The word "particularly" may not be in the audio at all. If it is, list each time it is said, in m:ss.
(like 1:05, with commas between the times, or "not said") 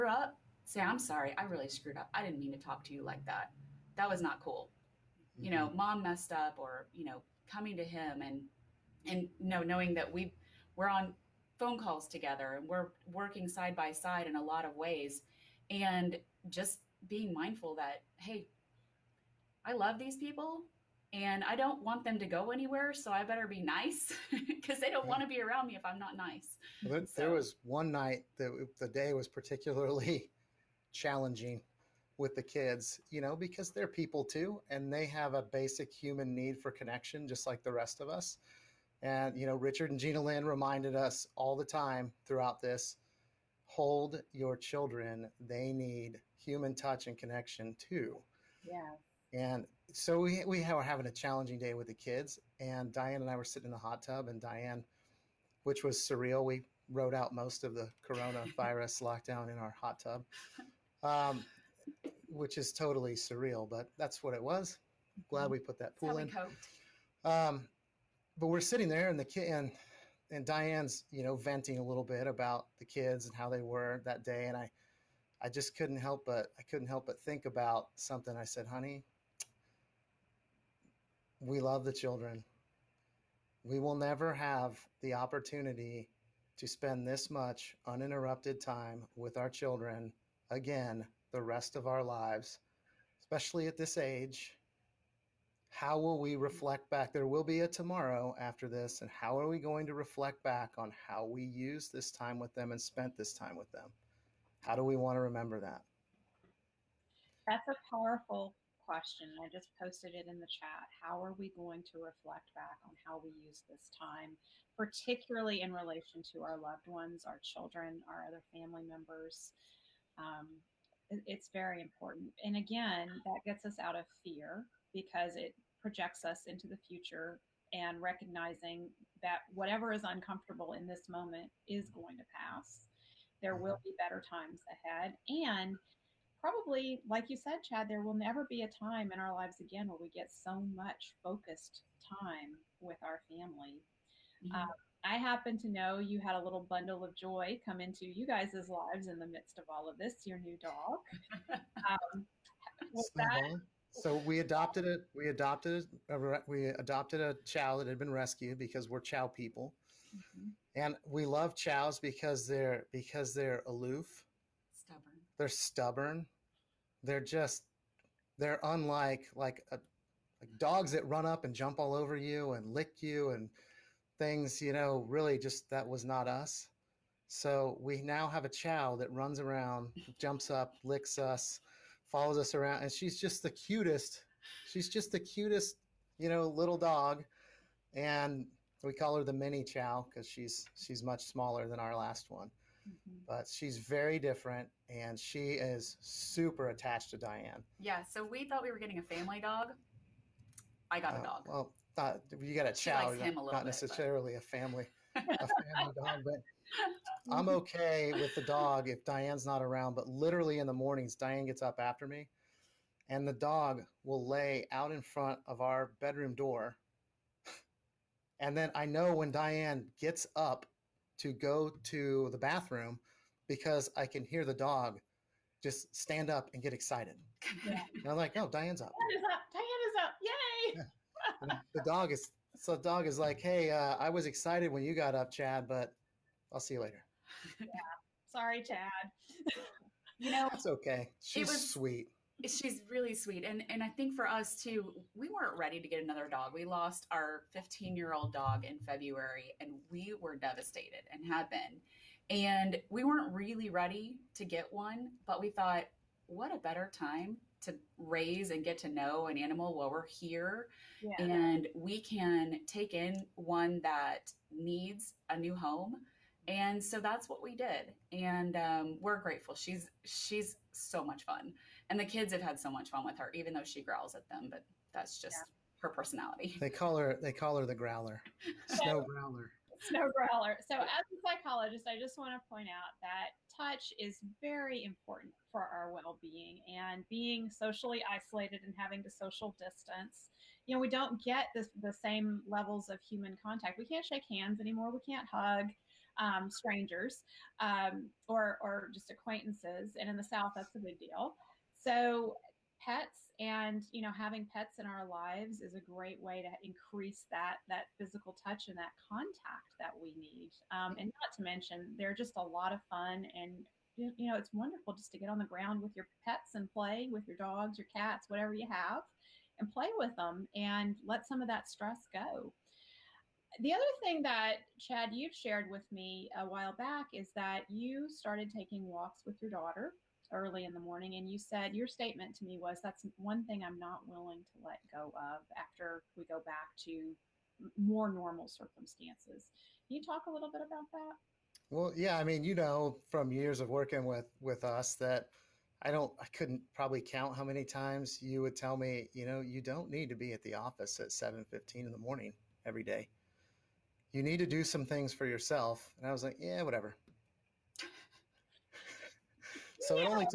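0:29, 1:54.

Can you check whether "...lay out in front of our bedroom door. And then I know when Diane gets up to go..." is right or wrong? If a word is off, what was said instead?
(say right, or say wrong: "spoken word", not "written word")
right.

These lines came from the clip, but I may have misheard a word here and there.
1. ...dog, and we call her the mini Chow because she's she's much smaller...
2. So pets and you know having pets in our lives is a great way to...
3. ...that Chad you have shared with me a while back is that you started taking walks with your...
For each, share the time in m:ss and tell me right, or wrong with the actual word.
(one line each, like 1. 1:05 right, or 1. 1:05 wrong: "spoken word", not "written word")
1. 3:06 right
2. 5:01 right
3. 5:24 right.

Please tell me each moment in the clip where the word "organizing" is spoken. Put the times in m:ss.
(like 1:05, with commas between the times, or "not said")
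not said.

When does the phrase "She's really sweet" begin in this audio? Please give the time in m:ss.
4:02.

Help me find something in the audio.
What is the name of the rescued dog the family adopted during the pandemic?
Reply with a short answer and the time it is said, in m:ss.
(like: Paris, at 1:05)
Snowball, at 2:33.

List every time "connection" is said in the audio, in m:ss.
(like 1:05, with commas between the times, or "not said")
0:36, 0:47.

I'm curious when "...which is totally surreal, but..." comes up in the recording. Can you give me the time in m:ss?
1:02.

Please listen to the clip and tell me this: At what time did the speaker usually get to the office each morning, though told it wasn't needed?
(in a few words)
7:15.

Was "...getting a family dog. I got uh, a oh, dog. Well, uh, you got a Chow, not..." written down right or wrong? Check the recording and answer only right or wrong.
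right.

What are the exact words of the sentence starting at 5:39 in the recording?
Can you talk a little bit about that?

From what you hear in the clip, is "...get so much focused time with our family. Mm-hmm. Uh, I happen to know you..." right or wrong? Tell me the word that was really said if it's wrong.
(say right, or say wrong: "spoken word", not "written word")
right.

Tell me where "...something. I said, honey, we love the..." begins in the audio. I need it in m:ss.
1:17.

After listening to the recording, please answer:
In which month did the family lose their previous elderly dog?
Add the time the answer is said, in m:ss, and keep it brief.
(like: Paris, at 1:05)
February, at 4:08.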